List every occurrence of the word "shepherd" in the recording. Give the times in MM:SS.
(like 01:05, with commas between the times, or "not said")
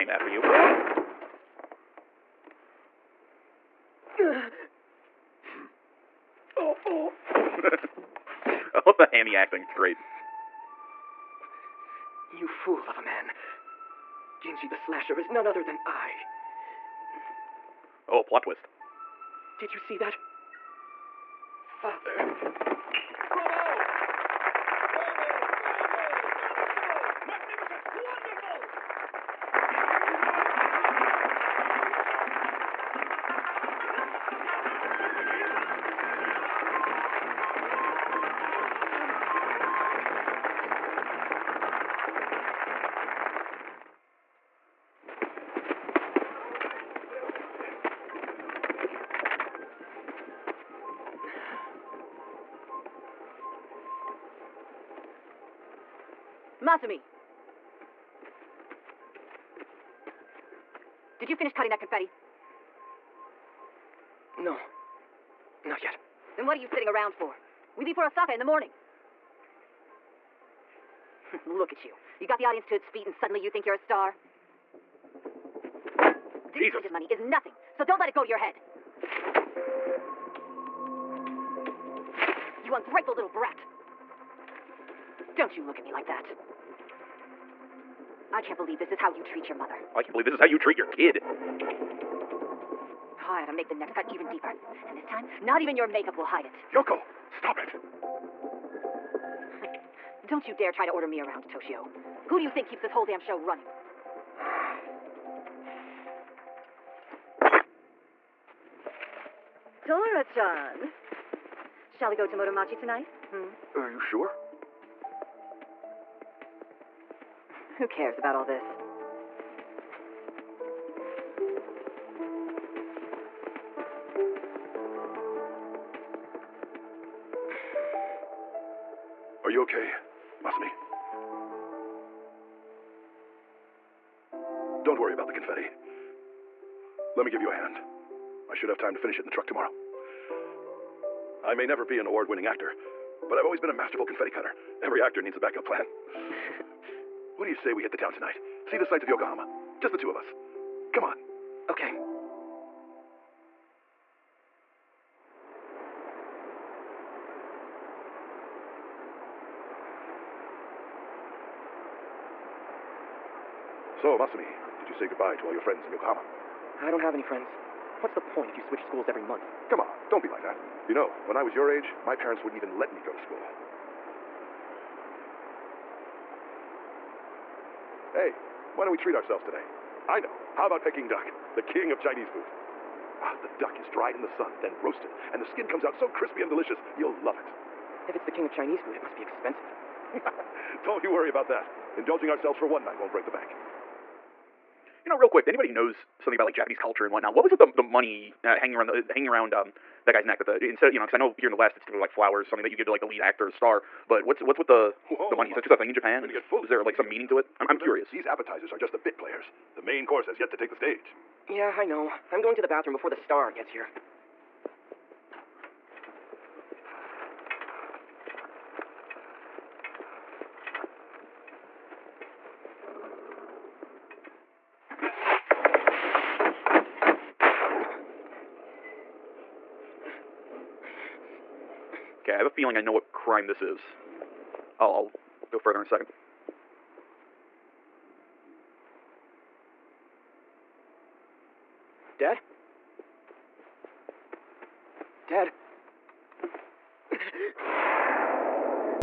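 not said.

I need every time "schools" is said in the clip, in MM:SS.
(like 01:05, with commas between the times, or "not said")
02:48, 02:53.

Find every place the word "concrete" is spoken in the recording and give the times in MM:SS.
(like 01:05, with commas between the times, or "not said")
not said.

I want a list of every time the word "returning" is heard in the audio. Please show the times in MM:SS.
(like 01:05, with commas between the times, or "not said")
not said.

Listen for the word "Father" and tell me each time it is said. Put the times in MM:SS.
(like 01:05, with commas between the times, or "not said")
00:21.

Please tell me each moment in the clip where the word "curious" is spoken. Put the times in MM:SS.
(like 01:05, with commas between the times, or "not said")
03:27.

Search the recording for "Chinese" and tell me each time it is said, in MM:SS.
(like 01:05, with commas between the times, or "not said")
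03:01, 03:08.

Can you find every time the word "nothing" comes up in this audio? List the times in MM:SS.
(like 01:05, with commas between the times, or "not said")
01:17.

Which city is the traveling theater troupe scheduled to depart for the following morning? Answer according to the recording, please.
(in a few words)
Osaka.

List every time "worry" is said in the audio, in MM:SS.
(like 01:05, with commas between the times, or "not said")
03:11.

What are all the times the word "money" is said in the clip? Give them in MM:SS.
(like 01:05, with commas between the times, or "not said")
01:16, 03:17, 03:25.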